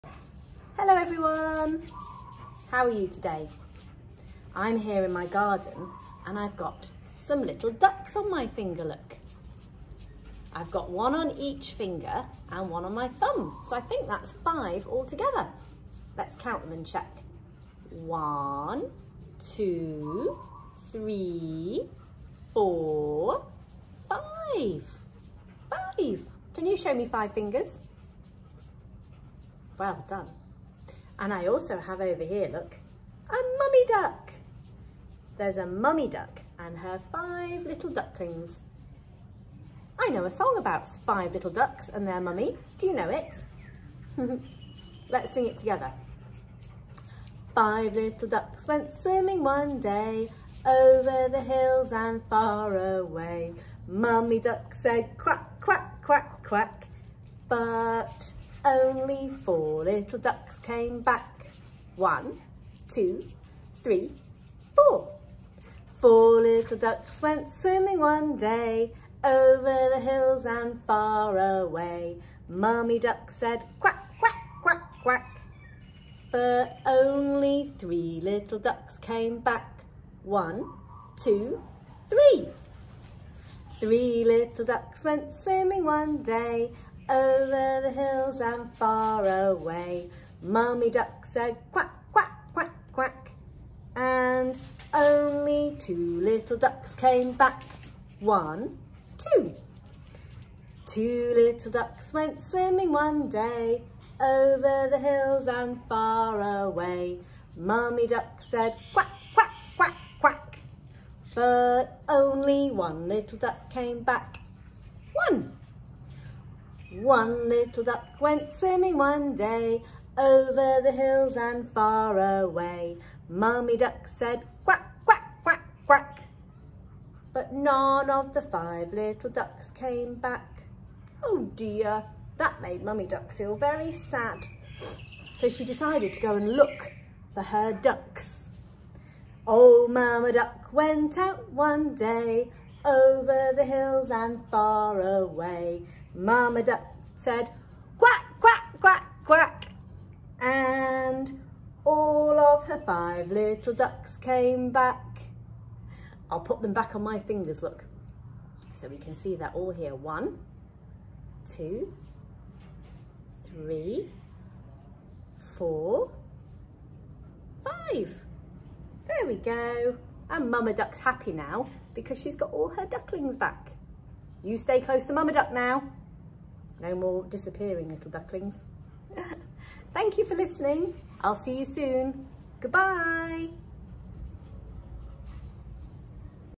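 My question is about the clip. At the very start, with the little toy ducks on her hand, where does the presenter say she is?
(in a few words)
garden.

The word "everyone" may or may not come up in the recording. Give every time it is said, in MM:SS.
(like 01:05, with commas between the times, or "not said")
00:00.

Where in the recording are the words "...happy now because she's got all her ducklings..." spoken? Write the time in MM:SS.
02:50.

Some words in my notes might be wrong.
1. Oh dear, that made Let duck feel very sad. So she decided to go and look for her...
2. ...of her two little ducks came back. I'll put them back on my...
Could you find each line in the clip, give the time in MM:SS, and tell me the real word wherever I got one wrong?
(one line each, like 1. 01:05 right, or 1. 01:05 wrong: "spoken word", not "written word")
1. 02:11 wrong: "Mummy", not "Let"
2. 02:32 wrong: "five", not "two".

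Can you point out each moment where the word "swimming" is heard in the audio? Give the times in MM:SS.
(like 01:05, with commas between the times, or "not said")
00:48, 01:07, 01:25, 01:42, 01:58.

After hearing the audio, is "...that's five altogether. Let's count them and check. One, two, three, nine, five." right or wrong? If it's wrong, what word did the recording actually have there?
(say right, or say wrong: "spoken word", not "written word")
wrong: "four", not "nine".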